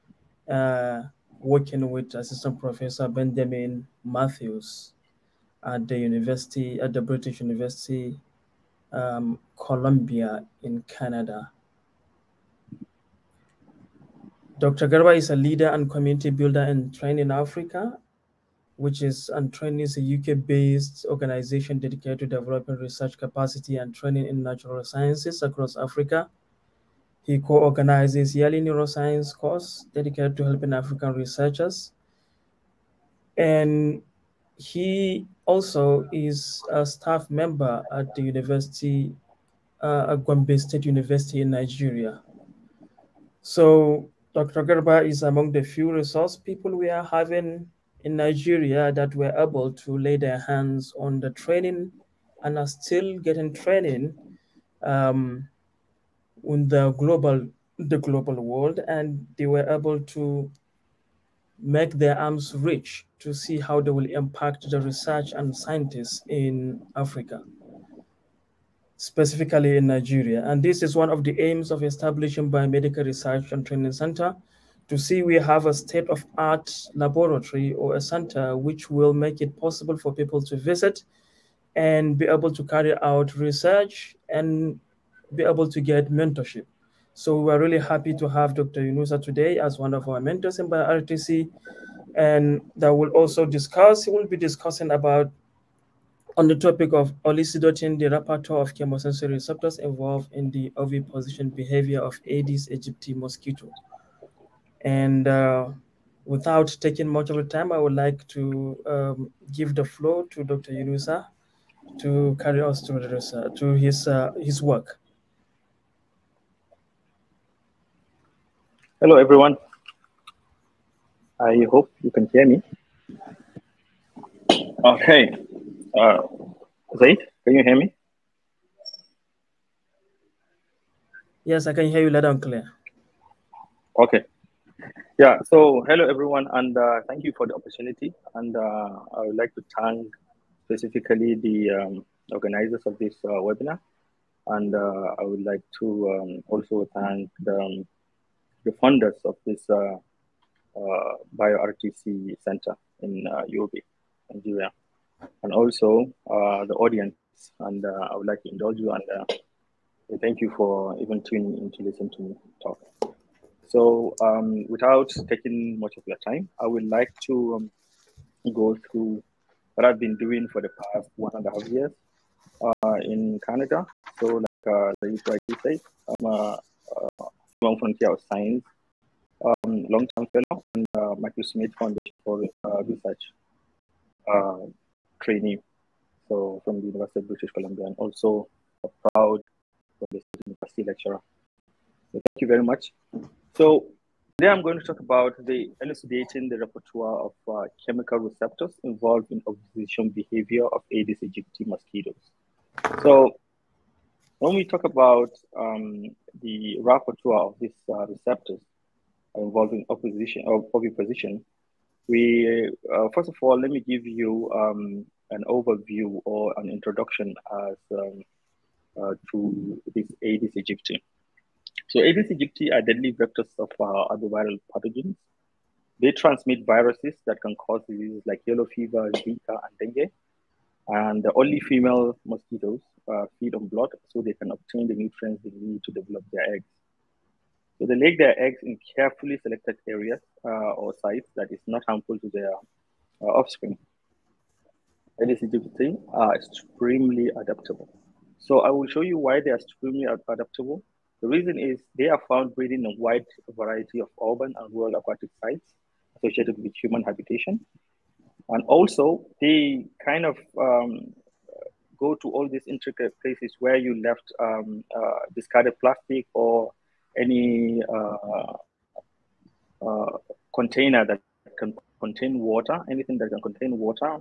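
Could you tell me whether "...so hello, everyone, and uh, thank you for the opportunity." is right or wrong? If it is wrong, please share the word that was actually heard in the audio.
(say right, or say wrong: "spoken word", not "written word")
right.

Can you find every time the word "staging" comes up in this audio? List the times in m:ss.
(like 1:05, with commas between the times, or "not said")
not said.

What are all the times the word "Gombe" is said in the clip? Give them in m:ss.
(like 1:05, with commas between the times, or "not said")
0:40.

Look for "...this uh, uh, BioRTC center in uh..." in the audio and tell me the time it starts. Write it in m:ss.
2:29.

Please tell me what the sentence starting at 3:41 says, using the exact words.
So Aedes aegypti are deadly vectors of uh, other viral pathogens.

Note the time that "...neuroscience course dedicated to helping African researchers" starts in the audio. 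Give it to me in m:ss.
0:28.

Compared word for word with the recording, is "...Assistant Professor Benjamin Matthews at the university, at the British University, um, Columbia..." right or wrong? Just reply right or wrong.
right.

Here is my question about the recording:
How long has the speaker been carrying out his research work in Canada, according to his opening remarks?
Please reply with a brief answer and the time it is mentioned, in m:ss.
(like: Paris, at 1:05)
One and a half years, at 2:51.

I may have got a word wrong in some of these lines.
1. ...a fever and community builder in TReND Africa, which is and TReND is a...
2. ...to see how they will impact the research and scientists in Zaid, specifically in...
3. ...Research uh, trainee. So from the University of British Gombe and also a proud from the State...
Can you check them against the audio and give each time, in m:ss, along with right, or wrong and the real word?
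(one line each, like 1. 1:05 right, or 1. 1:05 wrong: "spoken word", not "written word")
1. 0:15 wrong: "leader", not "fever"
2. 1:03 wrong: "Africa", not "Zaid"
3. 3:02 wrong: "Columbia", not "Gombe".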